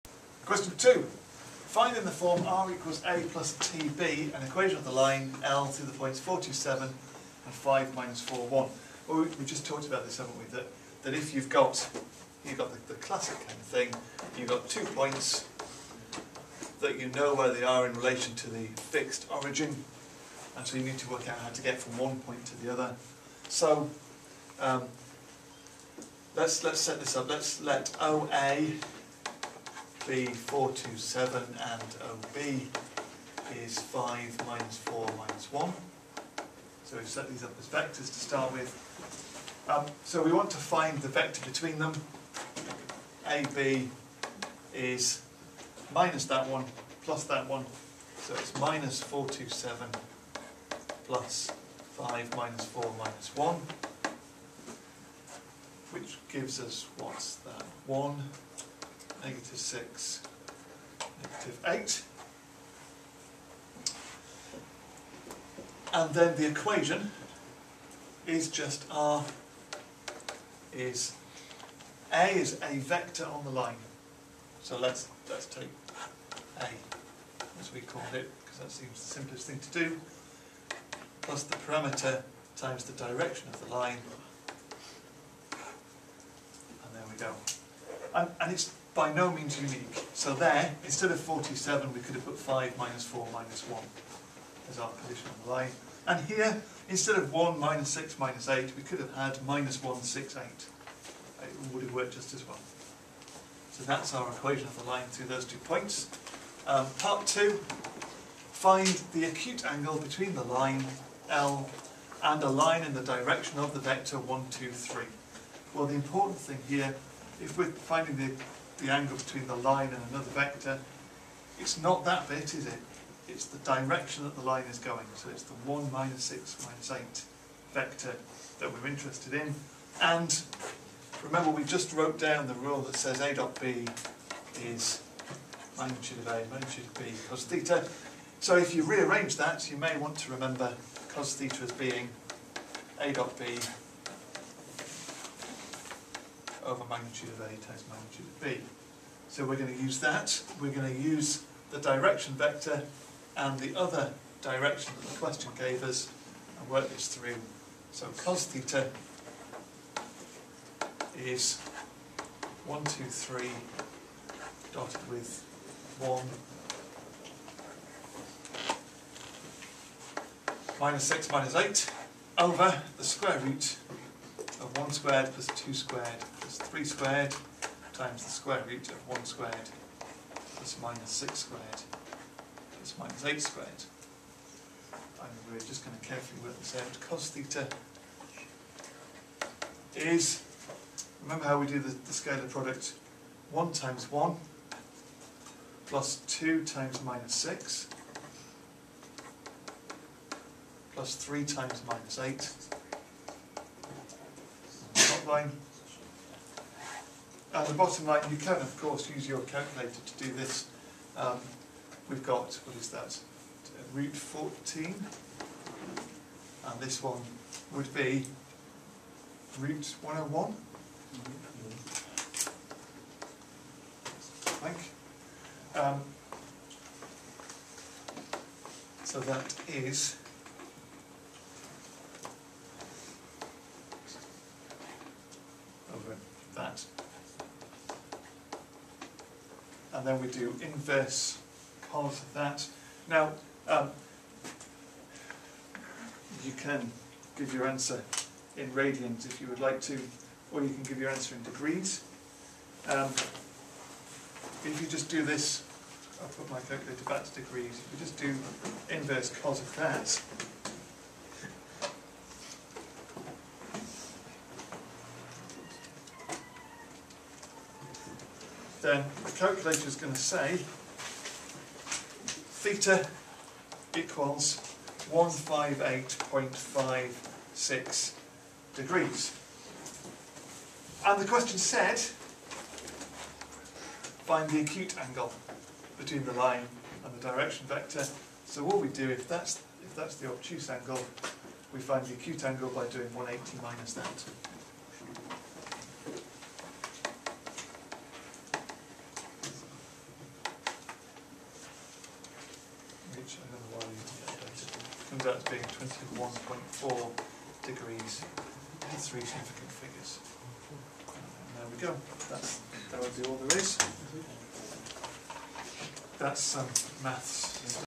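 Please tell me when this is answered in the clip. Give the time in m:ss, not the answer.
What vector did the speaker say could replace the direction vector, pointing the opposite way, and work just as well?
1:39.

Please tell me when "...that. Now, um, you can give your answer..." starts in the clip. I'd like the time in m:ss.
4:02.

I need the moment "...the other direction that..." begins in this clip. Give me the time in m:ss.
2:33.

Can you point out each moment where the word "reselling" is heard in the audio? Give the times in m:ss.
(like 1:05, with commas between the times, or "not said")
not said.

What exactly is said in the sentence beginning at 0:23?
So um, let's let's set this up.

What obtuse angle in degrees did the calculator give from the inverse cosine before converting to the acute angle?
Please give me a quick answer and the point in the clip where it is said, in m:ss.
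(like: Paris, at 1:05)
158.56 degrees, at 4:35.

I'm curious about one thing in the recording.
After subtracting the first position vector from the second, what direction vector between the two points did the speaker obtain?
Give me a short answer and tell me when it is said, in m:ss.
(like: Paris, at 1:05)
1, -6, -8, at 0:57.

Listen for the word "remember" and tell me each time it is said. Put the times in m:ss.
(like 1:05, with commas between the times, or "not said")
2:11, 2:20, 3:11.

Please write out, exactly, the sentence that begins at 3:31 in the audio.
Um, we've got, what is that, root 14, and this one would be root 101, I think.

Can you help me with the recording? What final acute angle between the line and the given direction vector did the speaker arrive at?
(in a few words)
21.4 degrees.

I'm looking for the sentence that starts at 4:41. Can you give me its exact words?
And the question said, find the acute angle between the line and the direction vector.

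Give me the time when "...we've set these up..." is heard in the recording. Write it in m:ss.
0:36.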